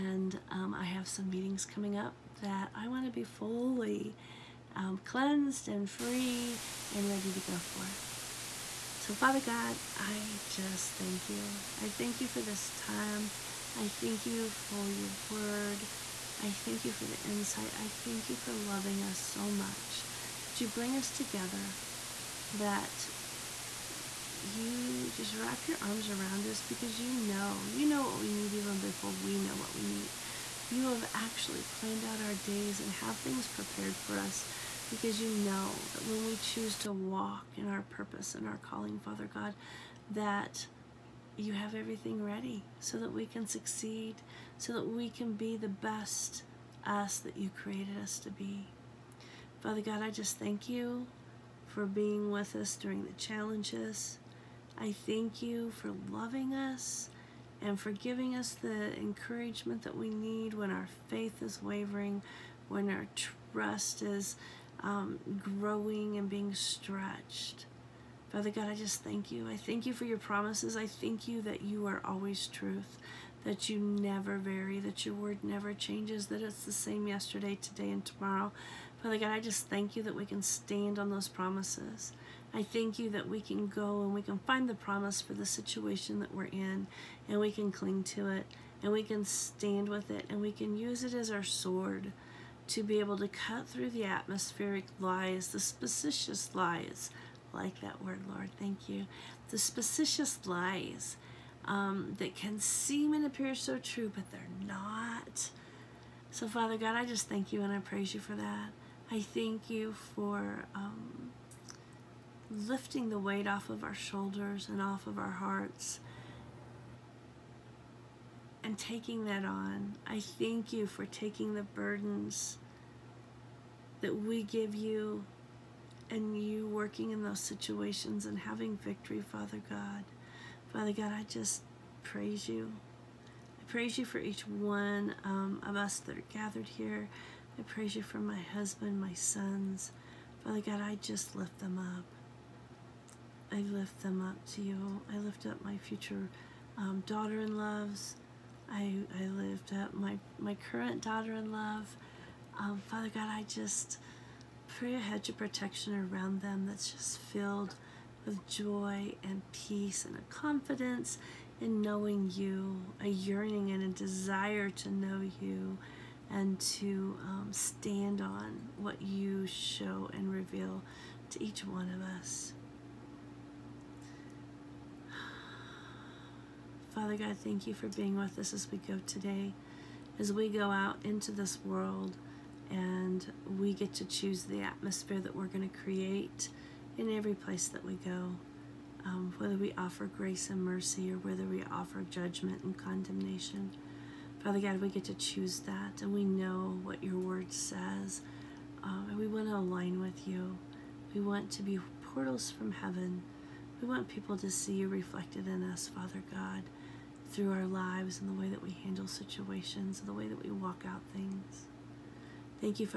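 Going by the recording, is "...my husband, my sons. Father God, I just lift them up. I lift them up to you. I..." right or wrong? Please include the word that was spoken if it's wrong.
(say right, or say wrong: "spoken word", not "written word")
right.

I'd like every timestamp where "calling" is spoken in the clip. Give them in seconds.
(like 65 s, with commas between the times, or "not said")
38 s.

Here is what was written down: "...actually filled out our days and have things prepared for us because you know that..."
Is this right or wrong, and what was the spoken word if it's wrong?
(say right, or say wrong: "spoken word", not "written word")
wrong: "planned", not "filled".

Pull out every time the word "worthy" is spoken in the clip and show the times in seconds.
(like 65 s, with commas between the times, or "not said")
not said.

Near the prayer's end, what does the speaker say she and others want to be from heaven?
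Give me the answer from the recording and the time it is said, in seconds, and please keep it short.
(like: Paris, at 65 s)
portals, at 202 s.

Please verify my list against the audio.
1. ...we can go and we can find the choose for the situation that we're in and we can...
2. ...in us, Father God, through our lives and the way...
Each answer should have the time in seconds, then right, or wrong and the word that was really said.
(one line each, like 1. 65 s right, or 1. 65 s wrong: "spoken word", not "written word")
1. 83 s wrong: "promise", not "choose"
2. 205 s right.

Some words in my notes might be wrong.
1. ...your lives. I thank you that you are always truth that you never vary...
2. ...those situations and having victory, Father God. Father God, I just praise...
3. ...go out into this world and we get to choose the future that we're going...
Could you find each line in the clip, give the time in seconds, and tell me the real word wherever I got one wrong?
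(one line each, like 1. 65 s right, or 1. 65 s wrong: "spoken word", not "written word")
1. 70 s wrong: "promises", not "lives"
2. 127 s right
3. 180 s wrong: "atmosphere", not "future".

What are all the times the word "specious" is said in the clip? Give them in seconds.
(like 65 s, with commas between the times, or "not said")
95 s, 99 s.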